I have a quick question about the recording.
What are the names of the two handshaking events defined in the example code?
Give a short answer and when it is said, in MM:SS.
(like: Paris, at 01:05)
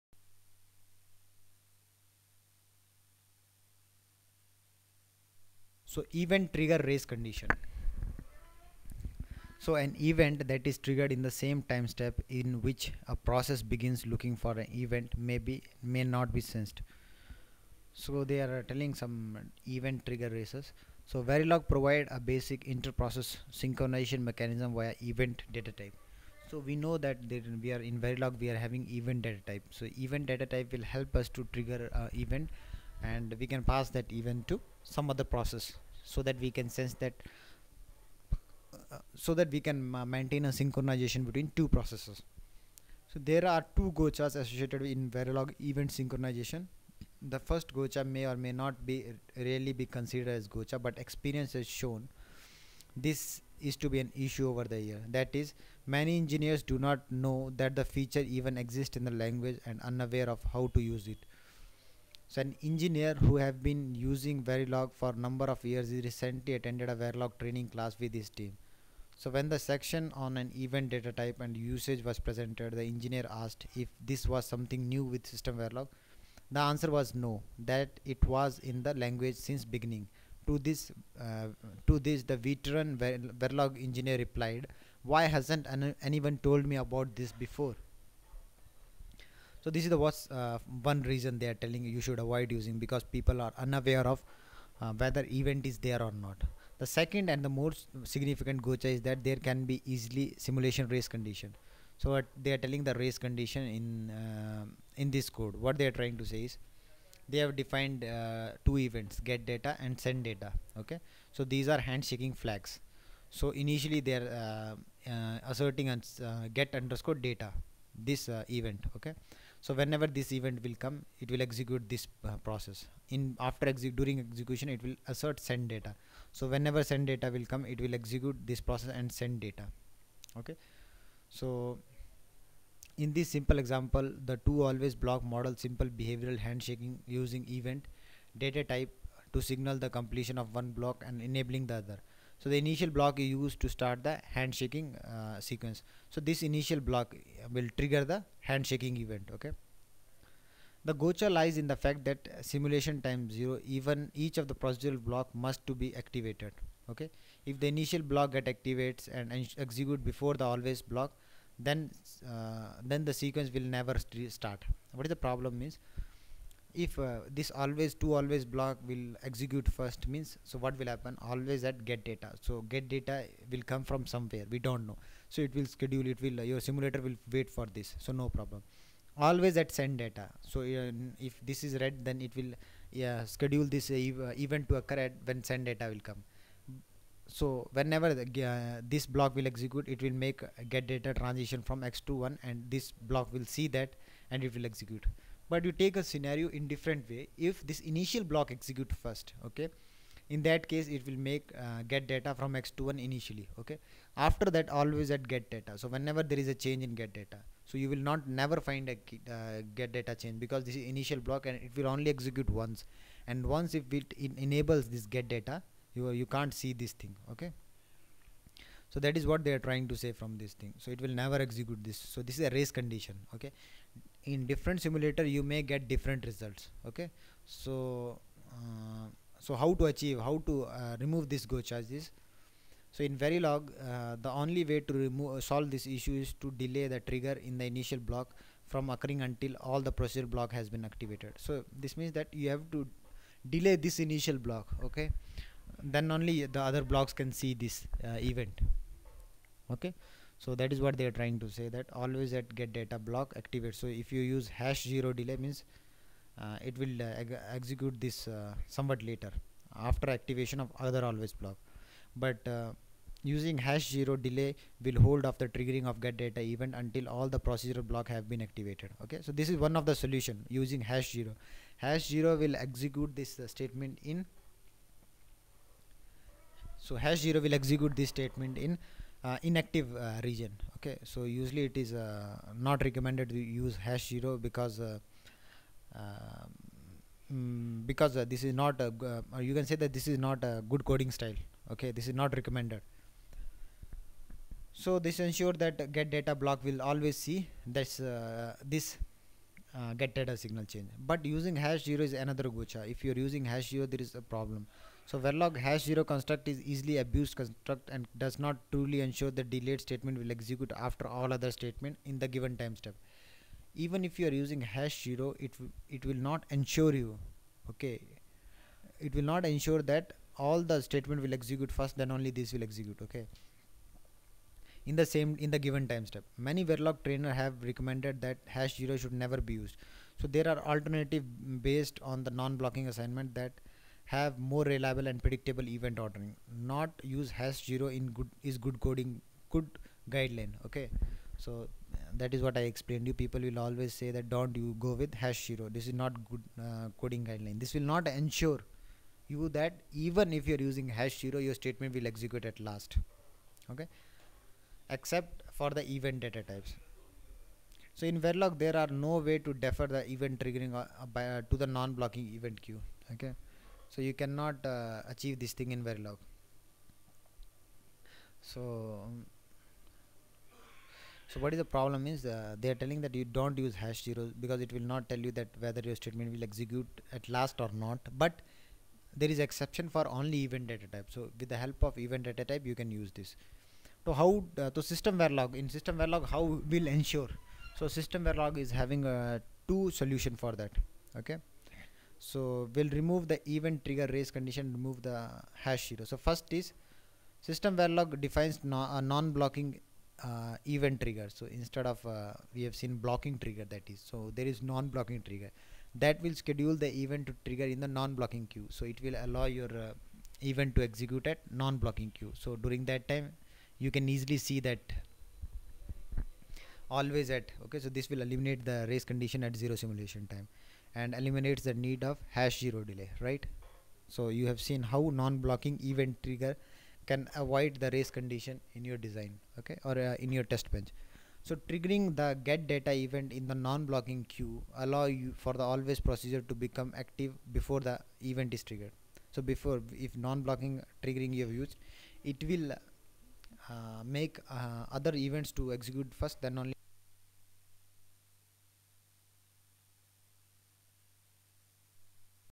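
get data and send data, at 01:49.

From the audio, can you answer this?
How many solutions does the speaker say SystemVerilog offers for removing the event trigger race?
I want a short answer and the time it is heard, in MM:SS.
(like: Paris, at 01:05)
2, at 06:29.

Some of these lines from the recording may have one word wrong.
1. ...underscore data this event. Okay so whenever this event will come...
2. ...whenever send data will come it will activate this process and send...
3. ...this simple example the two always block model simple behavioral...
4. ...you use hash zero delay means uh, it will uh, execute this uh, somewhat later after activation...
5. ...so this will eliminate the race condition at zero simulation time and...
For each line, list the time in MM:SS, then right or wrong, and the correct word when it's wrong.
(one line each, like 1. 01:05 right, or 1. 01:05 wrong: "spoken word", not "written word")
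1. 01:56 right
2. 02:06 wrong: "execute", not "activate"
3. 02:13 right
4. 04:14 right
5. 06:57 right.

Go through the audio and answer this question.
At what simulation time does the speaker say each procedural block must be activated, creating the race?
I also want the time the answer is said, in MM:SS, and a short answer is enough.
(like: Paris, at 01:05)
0, at 02:33.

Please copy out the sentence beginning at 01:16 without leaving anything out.
The answer was no, that it was in the language since beginning.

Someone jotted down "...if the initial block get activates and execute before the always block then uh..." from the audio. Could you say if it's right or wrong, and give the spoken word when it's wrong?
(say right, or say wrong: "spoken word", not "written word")
right.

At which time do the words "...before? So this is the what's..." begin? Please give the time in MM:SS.
01:27.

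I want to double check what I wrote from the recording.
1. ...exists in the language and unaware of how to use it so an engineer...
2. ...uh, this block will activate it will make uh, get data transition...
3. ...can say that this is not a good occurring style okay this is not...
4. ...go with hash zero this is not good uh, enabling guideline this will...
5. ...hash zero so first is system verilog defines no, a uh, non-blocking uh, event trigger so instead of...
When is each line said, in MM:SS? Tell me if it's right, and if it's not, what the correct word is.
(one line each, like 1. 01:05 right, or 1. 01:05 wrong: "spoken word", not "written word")
1. 00:58 right
2. 03:08 wrong: "execute", not "activate"
3. 04:49 wrong: "coding", not "occurring"
4. 05:44 wrong: "coding", not "enabling"
5. 06:35 right.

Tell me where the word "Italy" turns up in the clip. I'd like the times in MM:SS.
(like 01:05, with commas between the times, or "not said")
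not said.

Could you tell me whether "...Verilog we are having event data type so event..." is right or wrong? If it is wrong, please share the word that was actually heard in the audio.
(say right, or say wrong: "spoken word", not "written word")
right.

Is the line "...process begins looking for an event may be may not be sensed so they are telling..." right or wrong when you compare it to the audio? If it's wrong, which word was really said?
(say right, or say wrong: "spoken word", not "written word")
right.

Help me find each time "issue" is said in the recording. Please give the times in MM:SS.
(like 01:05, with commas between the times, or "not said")
00:54, 03:55.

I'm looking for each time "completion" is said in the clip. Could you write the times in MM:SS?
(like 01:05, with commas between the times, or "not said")
02:19.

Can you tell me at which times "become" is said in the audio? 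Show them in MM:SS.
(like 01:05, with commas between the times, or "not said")
07:16.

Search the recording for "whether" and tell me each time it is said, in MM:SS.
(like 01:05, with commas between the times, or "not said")
01:34, 06:15.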